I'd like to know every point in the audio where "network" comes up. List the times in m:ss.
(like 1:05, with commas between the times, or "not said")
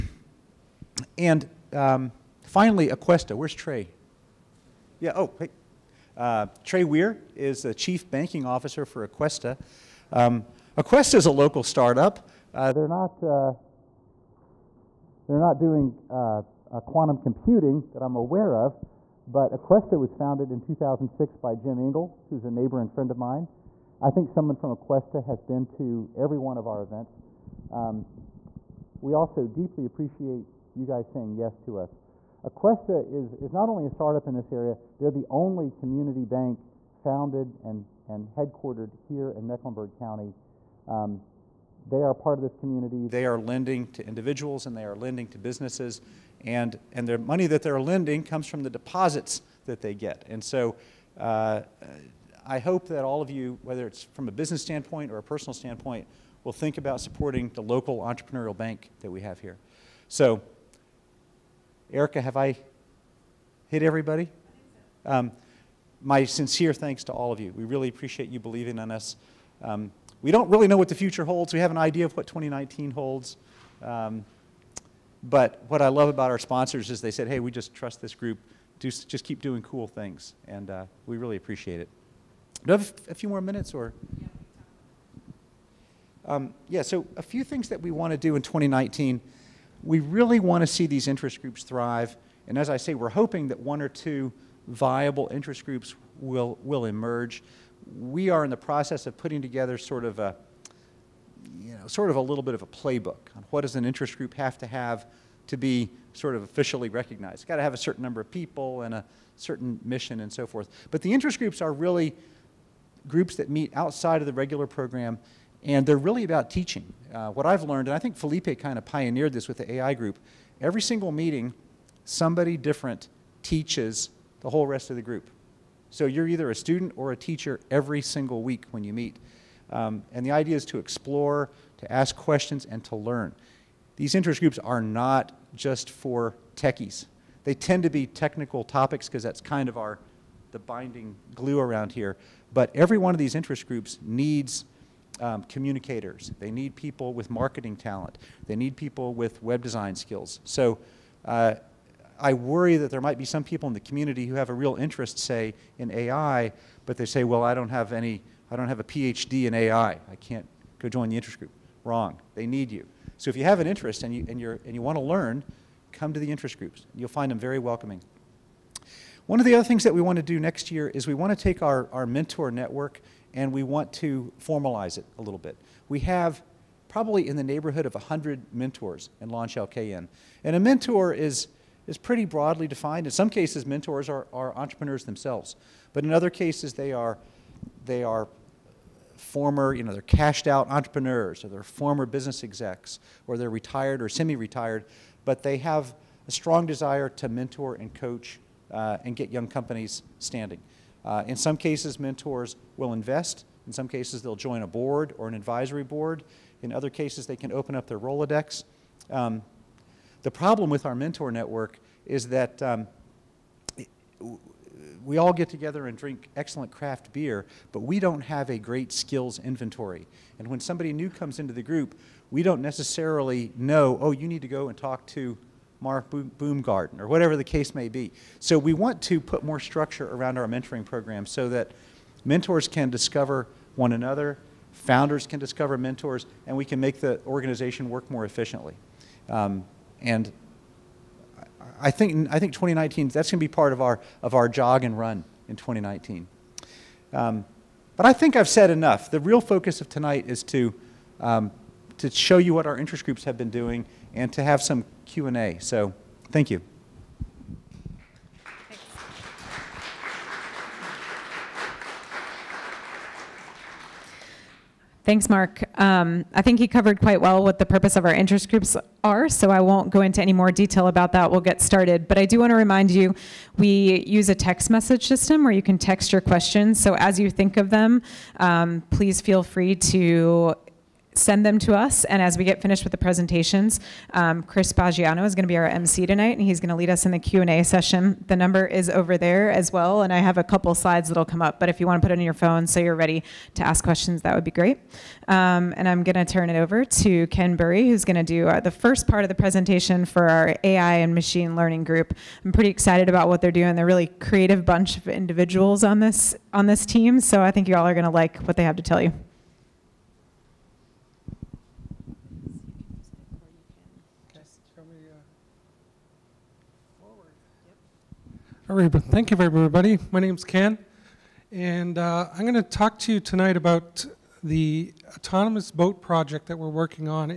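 2:52, 3:31.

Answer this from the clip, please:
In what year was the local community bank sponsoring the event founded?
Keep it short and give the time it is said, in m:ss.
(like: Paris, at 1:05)
2006, at 0:20.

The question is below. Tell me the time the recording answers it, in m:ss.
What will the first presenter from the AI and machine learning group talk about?
5:25.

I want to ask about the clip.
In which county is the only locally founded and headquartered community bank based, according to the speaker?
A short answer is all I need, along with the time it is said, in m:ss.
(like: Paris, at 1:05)
Mecklenburg County, at 0:39.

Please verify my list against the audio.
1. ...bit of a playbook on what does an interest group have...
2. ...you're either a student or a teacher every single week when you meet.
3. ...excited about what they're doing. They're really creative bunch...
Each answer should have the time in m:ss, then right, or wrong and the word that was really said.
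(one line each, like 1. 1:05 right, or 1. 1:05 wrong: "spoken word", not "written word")
1. 1:42 right
2. 2:06 right
3. 5:02 right.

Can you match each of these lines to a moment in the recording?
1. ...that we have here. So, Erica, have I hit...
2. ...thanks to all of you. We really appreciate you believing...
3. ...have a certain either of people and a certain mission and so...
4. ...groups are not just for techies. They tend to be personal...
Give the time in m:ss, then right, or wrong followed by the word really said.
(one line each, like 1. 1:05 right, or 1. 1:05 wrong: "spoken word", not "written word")
1. 0:59 right
2. 1:06 right
3. 1:47 wrong: "number", not "either"
4. 2:14 wrong: "technical", not "personal".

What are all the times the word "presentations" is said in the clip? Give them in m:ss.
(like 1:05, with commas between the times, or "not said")
4:42, 4:59.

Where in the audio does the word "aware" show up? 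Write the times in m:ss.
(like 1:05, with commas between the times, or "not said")
0:18.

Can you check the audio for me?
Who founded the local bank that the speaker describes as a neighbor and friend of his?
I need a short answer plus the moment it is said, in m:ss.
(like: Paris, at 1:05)
Jim Engel, at 0:21.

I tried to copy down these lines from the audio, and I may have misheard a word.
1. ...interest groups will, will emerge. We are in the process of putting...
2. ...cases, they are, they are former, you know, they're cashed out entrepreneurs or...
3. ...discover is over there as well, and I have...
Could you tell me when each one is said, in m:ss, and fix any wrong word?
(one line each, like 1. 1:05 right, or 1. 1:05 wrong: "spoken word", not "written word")
1. 1:35 right
2. 3:06 right
3. 4:48 wrong: "number", not "discover".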